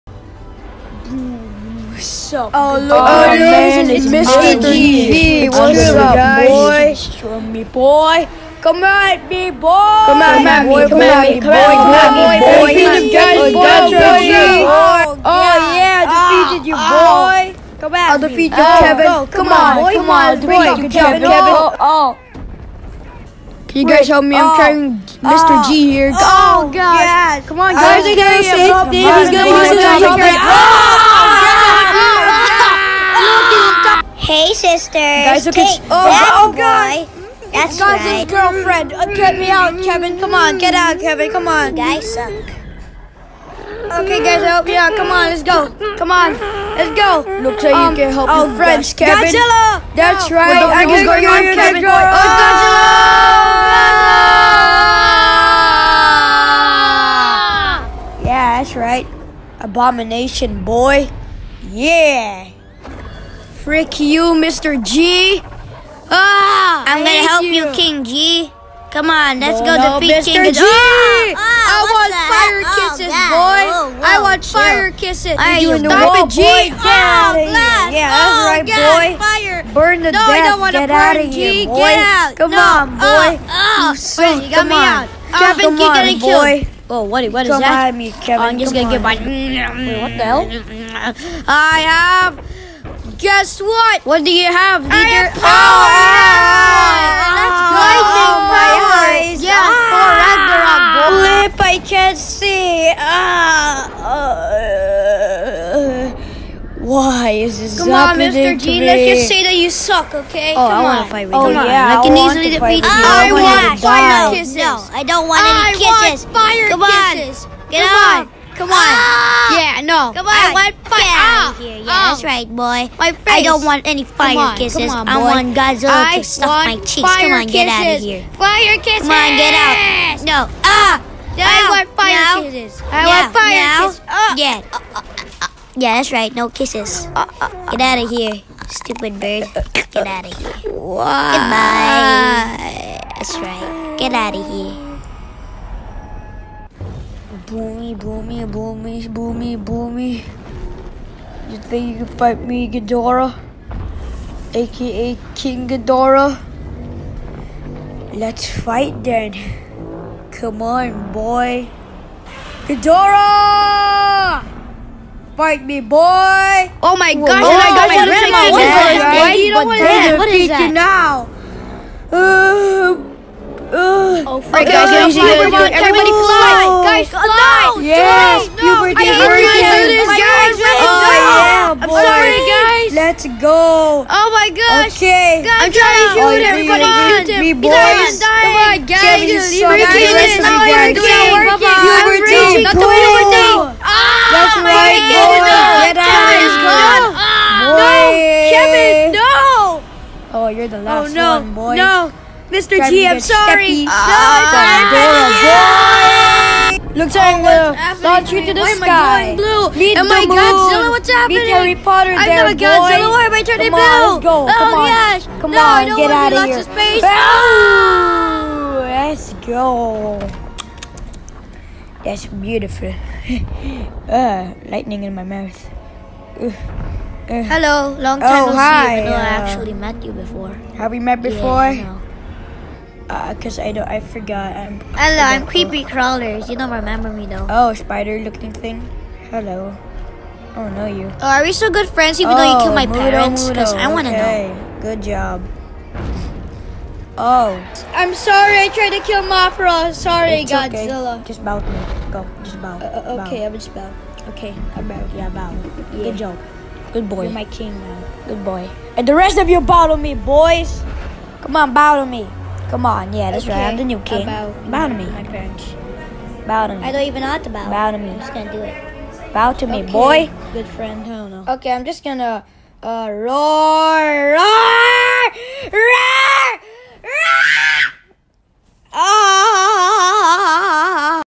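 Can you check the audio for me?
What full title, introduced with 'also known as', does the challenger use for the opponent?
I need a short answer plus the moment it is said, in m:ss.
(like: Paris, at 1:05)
King Ghidorah, at 2:35.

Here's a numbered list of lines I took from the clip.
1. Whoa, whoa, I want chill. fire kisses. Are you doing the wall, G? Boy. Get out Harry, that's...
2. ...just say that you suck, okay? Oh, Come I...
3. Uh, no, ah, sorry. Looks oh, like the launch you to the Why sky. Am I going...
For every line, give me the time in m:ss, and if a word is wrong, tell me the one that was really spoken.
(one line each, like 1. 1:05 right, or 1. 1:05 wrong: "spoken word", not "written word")
1. 1:13 wrong: "Yeah", not "Harry"
2. 1:49 right
3. 3:23 right.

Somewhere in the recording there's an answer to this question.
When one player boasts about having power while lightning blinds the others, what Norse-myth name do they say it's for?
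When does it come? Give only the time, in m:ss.
1:41.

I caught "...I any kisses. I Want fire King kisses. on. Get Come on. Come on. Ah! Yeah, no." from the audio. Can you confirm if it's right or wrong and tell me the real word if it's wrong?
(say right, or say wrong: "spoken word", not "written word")
wrong: "Come", not "King".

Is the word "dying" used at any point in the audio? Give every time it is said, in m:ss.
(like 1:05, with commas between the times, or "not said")
3:08.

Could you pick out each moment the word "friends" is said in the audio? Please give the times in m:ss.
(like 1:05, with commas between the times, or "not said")
4:01, 4:30.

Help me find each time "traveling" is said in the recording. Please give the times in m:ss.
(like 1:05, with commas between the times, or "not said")
not said.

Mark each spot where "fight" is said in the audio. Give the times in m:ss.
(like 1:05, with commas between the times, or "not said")
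1:51, 2:32, 2:38, 2:45.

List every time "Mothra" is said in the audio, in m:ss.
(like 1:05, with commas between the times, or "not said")
4:09.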